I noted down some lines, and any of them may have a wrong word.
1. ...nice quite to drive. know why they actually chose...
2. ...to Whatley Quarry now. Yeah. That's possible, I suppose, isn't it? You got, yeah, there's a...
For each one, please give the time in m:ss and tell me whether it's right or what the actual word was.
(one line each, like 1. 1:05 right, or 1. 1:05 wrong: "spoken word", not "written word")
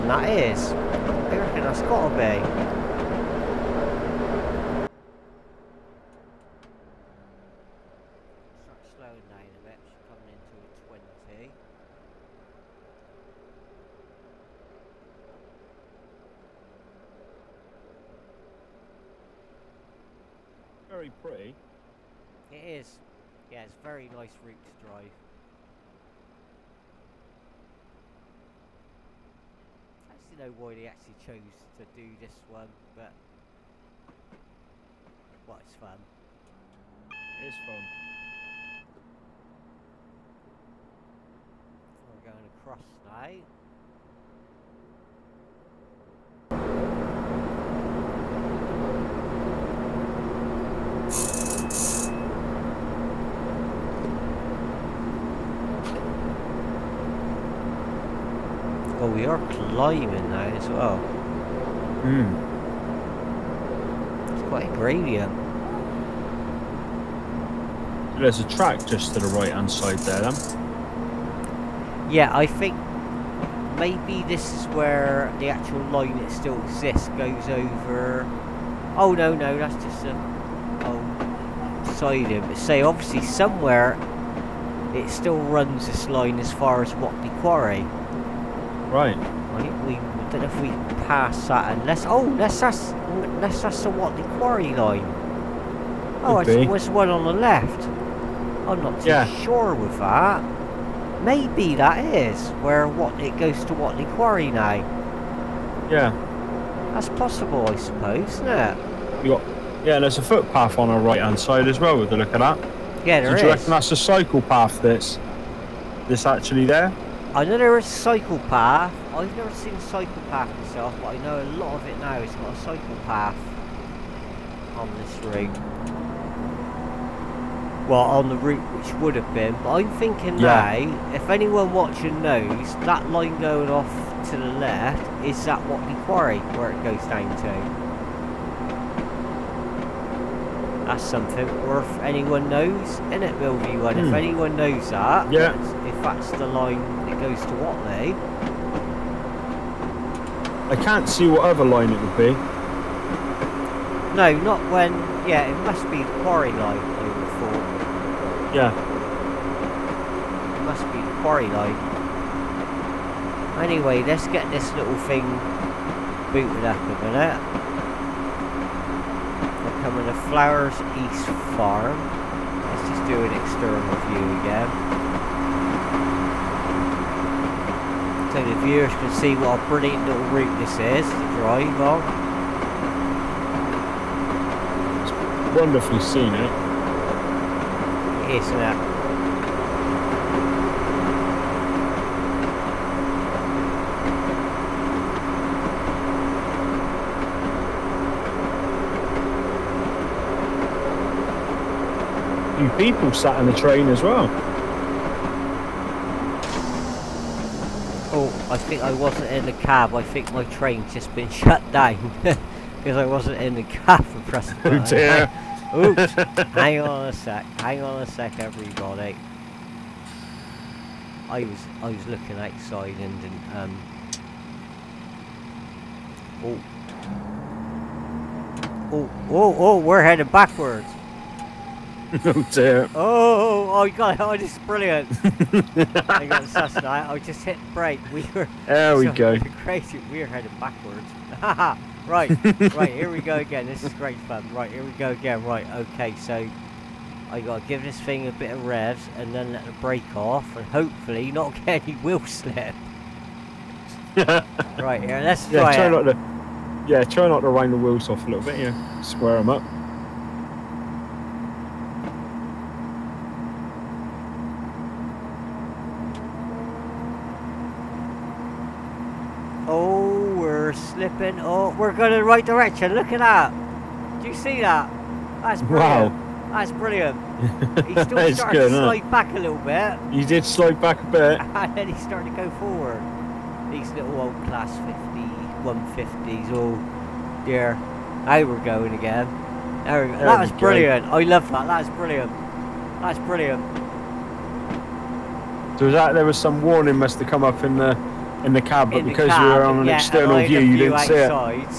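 1. 0:24 wrong: "route", not "quite"
2. 1:43 right.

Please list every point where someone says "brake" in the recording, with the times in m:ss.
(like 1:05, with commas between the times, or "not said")
3:57, 4:09.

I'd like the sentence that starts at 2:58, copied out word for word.
so the viewers can see what a brilliant little route this is to drive on.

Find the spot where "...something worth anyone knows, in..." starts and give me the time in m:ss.
2:21.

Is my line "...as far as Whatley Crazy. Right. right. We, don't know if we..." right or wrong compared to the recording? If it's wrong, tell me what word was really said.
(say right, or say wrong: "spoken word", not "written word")
wrong: "Quarry", not "Crazy".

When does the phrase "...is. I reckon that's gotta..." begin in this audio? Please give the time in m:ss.
0:00.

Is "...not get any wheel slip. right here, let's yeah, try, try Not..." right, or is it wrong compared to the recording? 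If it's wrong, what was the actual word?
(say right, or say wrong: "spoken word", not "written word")
right.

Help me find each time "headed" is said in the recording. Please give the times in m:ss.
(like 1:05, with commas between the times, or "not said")
3:50, 4:00.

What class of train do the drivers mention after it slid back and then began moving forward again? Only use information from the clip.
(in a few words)
Class 150.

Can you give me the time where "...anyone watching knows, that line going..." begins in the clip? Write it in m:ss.
2:11.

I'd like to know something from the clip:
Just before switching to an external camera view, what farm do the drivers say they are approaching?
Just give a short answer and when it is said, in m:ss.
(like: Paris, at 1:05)
Flowers East Farm, at 2:50.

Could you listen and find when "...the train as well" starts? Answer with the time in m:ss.
3:23.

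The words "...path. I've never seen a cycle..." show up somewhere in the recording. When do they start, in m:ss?
1:58.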